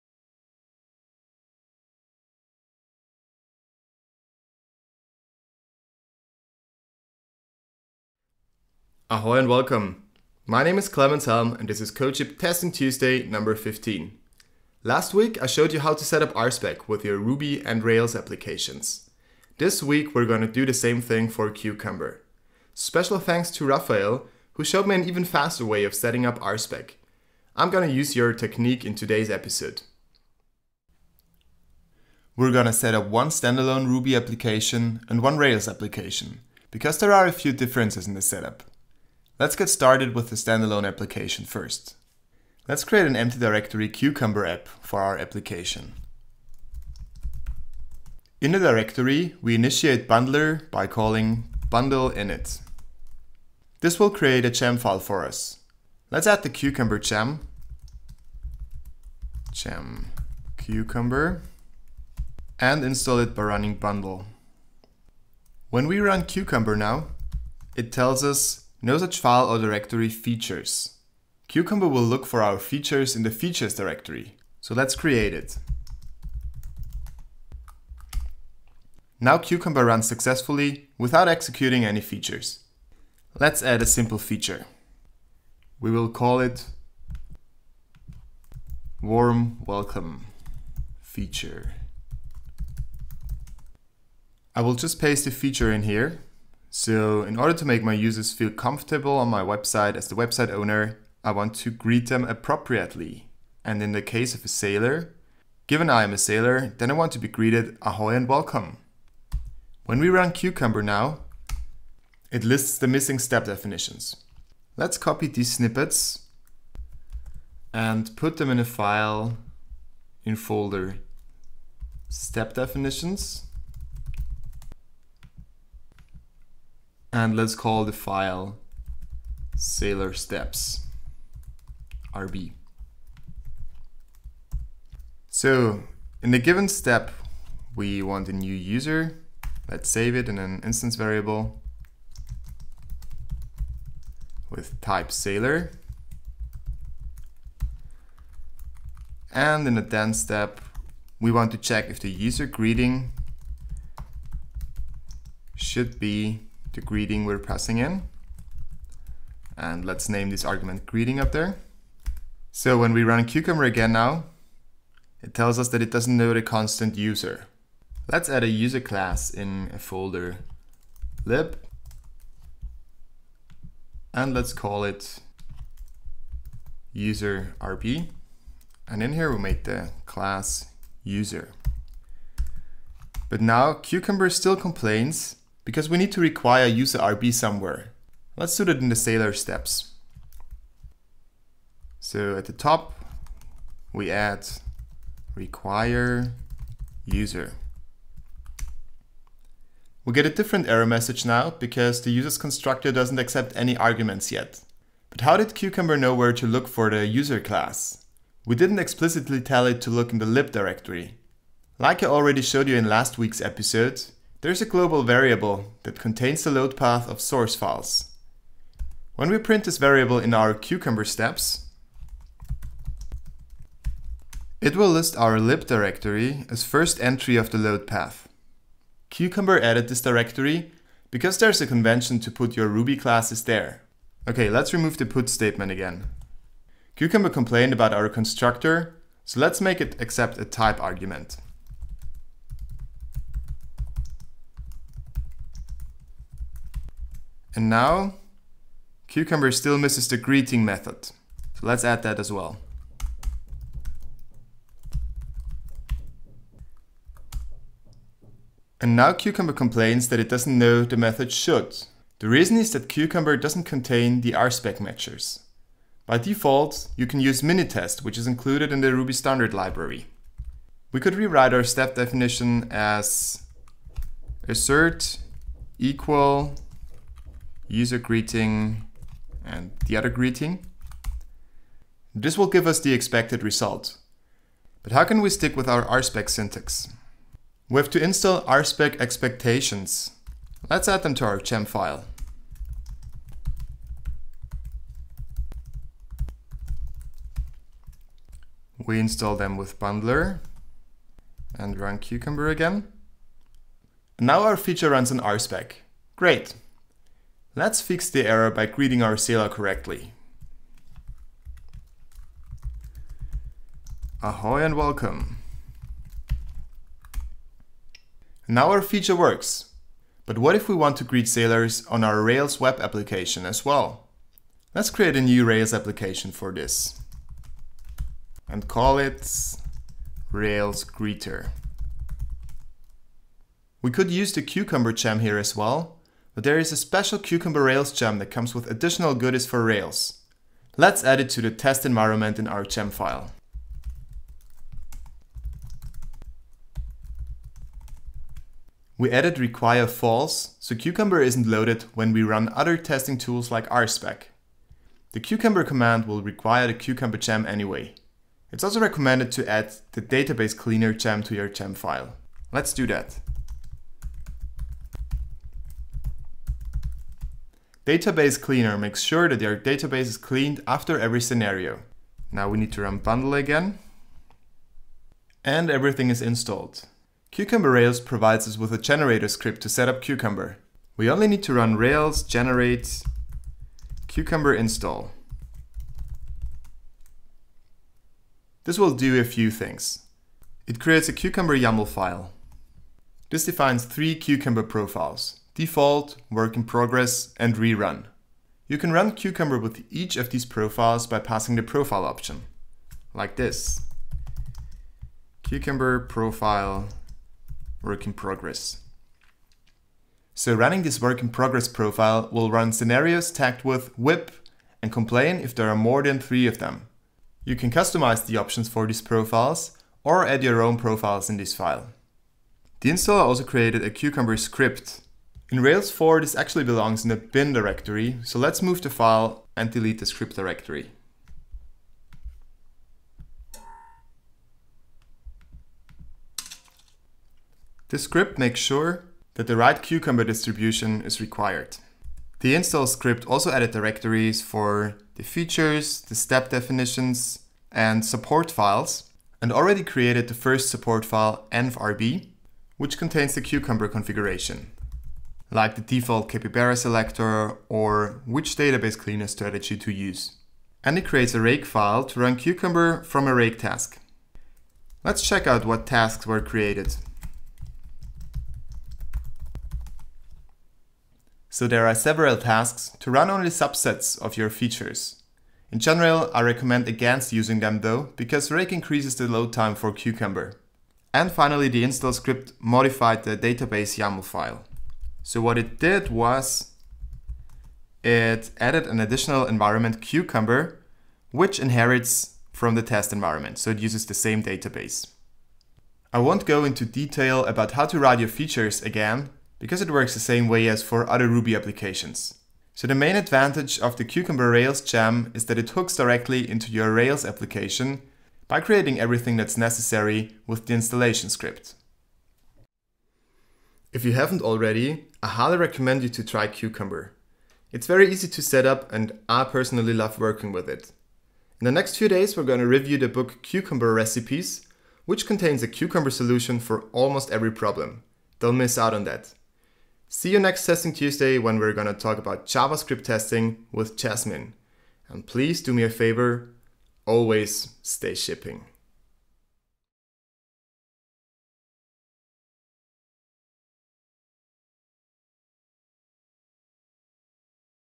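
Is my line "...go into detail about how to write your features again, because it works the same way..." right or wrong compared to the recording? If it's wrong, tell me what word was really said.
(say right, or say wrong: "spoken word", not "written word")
right.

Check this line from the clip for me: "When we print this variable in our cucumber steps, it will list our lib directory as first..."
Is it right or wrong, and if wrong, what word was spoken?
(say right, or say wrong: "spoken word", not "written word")
right.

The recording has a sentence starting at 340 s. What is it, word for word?
Let's add it to the test environment in our gem file.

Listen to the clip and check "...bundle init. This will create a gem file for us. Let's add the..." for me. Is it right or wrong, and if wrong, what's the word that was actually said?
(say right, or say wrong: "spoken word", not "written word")
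right.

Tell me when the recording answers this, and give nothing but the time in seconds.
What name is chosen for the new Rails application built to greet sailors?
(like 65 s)
330 s.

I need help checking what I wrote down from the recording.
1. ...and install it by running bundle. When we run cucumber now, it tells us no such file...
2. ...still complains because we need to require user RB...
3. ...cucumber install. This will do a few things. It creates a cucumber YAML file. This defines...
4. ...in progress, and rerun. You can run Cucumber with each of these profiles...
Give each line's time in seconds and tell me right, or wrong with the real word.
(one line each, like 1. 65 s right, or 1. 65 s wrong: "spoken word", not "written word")
1. 62 s right
2. 184 s right
3. 384 s right
4. 396 s right.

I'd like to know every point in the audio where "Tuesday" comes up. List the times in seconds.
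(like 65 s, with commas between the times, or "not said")
12 s, 530 s.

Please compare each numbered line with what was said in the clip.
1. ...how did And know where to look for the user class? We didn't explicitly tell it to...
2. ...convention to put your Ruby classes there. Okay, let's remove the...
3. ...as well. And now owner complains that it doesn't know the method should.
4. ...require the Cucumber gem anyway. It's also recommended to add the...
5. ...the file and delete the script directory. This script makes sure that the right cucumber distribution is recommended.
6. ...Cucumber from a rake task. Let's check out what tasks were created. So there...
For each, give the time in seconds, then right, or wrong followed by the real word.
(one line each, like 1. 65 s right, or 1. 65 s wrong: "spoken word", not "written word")
1. 205 s wrong: "Cucumber", not "And"
2. 231 s right
3. 252 s wrong: "cucumber", not "owner"
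4. 356 s right
5. 428 s wrong: "required", not "recommended"
6. 462 s right.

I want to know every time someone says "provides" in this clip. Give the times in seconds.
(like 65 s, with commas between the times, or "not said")
377 s.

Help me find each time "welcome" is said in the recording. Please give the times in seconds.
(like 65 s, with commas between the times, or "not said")
9 s, 89 s, 108 s, 314 s.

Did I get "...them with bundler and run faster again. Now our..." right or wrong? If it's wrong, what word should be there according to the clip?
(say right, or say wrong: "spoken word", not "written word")
wrong: "cucumber", not "faster".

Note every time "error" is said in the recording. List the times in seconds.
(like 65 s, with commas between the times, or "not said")
200 s, 308 s.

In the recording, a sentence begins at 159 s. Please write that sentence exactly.
And let's name this argument greeting up there.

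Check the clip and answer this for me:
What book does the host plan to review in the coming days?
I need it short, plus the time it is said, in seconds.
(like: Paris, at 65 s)
Cucumber Recipes, at 523 s.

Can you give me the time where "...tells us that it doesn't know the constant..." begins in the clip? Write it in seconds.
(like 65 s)
165 s.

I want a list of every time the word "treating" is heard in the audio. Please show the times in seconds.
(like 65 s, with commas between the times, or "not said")
not said.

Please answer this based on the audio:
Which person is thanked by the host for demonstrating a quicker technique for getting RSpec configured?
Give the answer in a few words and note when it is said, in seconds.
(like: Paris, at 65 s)
Raphael, at 23 s.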